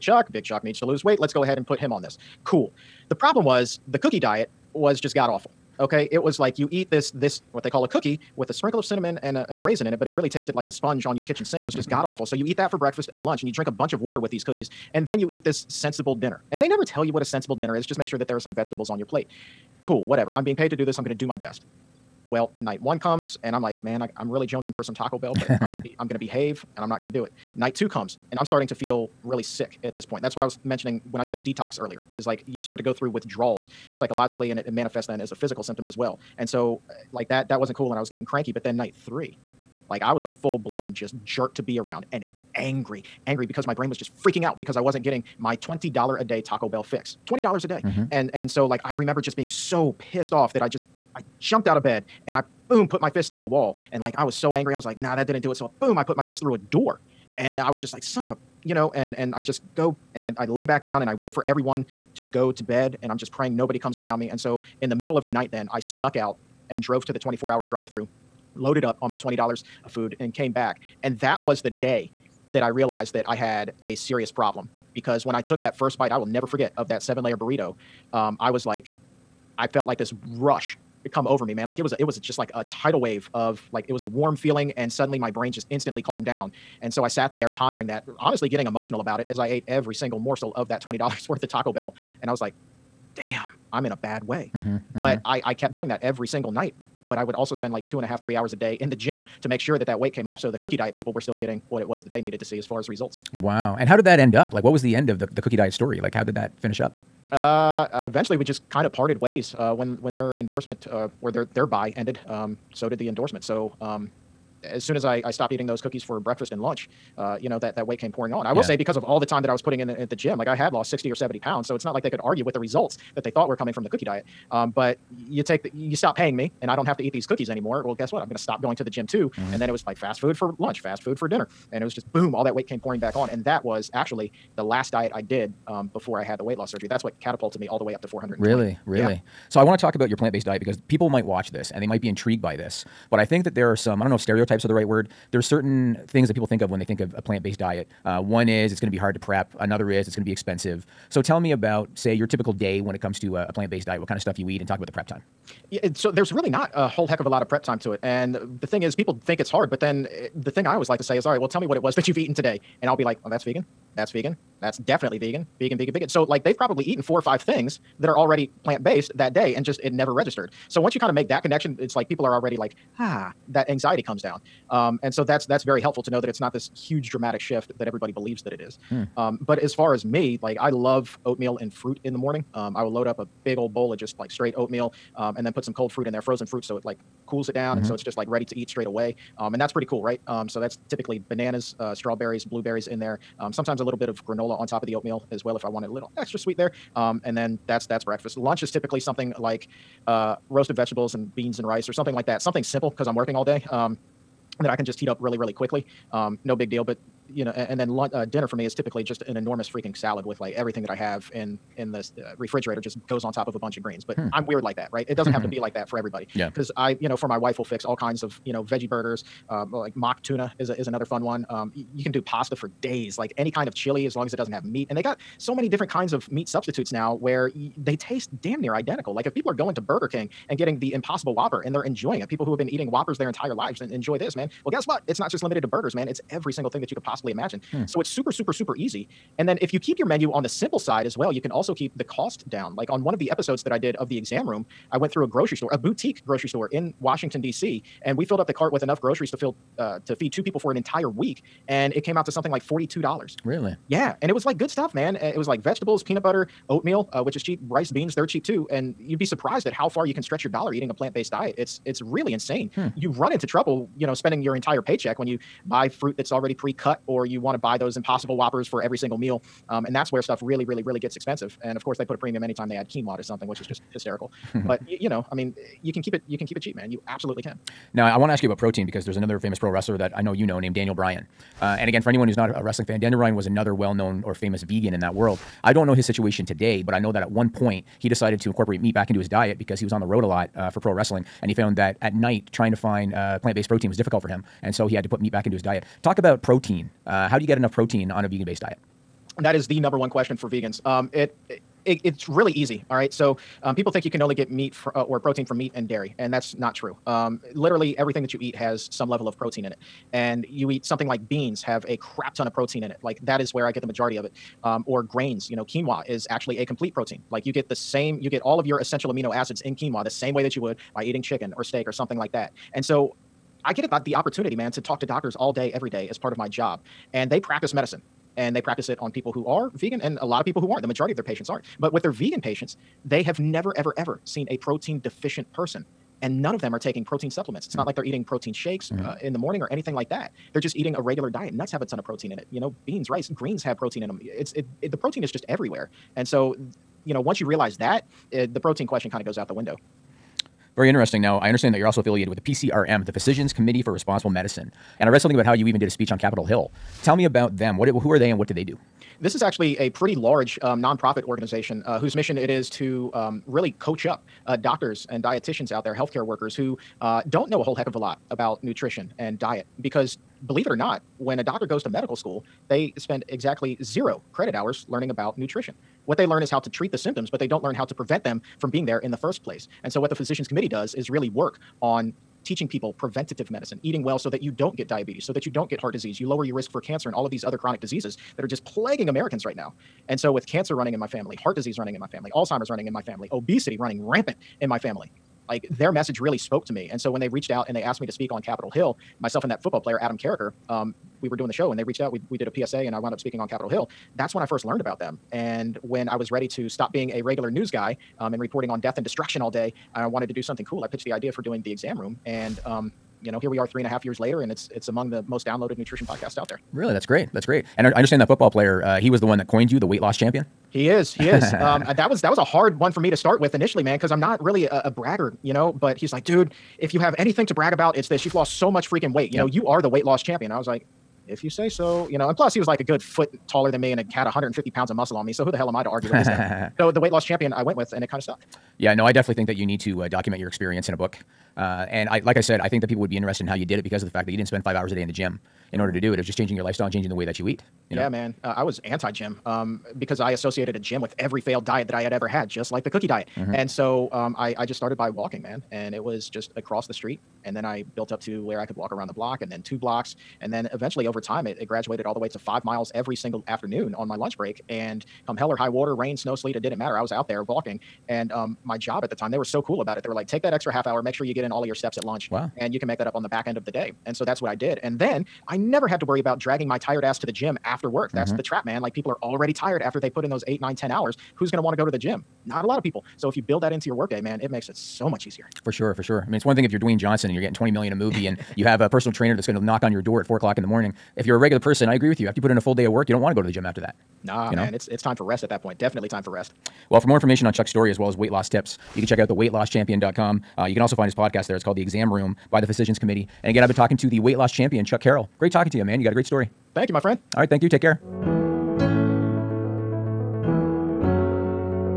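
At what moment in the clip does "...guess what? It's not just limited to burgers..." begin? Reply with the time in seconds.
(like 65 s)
234 s.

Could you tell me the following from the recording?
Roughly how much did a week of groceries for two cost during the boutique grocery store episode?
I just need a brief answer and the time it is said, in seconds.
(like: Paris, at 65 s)
$42, at 252 s.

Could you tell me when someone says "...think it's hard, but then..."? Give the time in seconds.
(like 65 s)
159 s.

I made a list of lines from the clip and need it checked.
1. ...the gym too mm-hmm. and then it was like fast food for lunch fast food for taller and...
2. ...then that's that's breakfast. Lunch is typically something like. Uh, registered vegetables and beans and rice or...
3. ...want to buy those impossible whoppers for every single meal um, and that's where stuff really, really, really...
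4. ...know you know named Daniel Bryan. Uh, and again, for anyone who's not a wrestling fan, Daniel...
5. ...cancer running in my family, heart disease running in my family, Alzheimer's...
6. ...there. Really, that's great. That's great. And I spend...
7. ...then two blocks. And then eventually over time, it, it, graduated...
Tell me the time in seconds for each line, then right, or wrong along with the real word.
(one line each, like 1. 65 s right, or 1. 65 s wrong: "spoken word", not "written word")
1. 128 s wrong: "dinner", not "taller"
2. 197 s wrong: "roasted", not "registered"
3. 267 s right
4. 280 s right
5. 390 s right
6. 416 s wrong: "understand", not "spend"
7. 459 s right.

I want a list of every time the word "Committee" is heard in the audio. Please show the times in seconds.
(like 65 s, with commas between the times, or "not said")
353 s, 380 s, 502 s.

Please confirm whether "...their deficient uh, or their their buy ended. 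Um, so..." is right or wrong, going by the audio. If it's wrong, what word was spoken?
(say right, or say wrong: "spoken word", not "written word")
wrong: "endorsement", not "deficient".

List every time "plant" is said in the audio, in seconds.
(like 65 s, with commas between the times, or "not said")
140 s, 147 s, 153 s, 168 s, 260 s, 293 s.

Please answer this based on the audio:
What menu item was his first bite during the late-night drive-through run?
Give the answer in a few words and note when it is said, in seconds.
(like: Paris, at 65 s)
seven layer burrito, at 77 s.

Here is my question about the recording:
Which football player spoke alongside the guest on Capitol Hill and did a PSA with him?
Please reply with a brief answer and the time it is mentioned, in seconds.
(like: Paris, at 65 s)
Adam Carriker, at 399 s.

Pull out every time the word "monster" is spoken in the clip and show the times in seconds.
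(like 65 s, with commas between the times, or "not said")
not said.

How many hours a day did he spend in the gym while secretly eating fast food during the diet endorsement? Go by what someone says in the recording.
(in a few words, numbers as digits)
two and a half, three hours.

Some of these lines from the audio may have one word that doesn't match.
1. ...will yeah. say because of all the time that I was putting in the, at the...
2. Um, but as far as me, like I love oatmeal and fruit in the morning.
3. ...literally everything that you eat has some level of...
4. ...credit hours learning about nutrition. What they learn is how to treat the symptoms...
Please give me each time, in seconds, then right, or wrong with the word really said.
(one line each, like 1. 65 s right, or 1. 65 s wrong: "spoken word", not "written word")
1. 118 s right
2. 179 s right
3. 307 s right
4. 374 s right.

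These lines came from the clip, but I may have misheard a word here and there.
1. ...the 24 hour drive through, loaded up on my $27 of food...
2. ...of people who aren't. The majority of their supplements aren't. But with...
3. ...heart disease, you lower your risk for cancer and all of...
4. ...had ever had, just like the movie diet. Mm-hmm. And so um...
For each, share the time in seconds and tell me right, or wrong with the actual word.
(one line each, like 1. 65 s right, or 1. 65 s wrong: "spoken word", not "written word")
1. 67 s wrong: "20", not "27"
2. 330 s wrong: "patients", not "supplements"
3. 385 s right
4. 452 s wrong: "cookie", not "movie".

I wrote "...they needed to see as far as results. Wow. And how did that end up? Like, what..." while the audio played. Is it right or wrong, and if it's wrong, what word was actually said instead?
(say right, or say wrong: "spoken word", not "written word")
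right.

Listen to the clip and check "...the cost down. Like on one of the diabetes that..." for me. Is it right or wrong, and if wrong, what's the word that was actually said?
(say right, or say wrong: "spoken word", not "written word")
wrong: "episodes", not "diabetes".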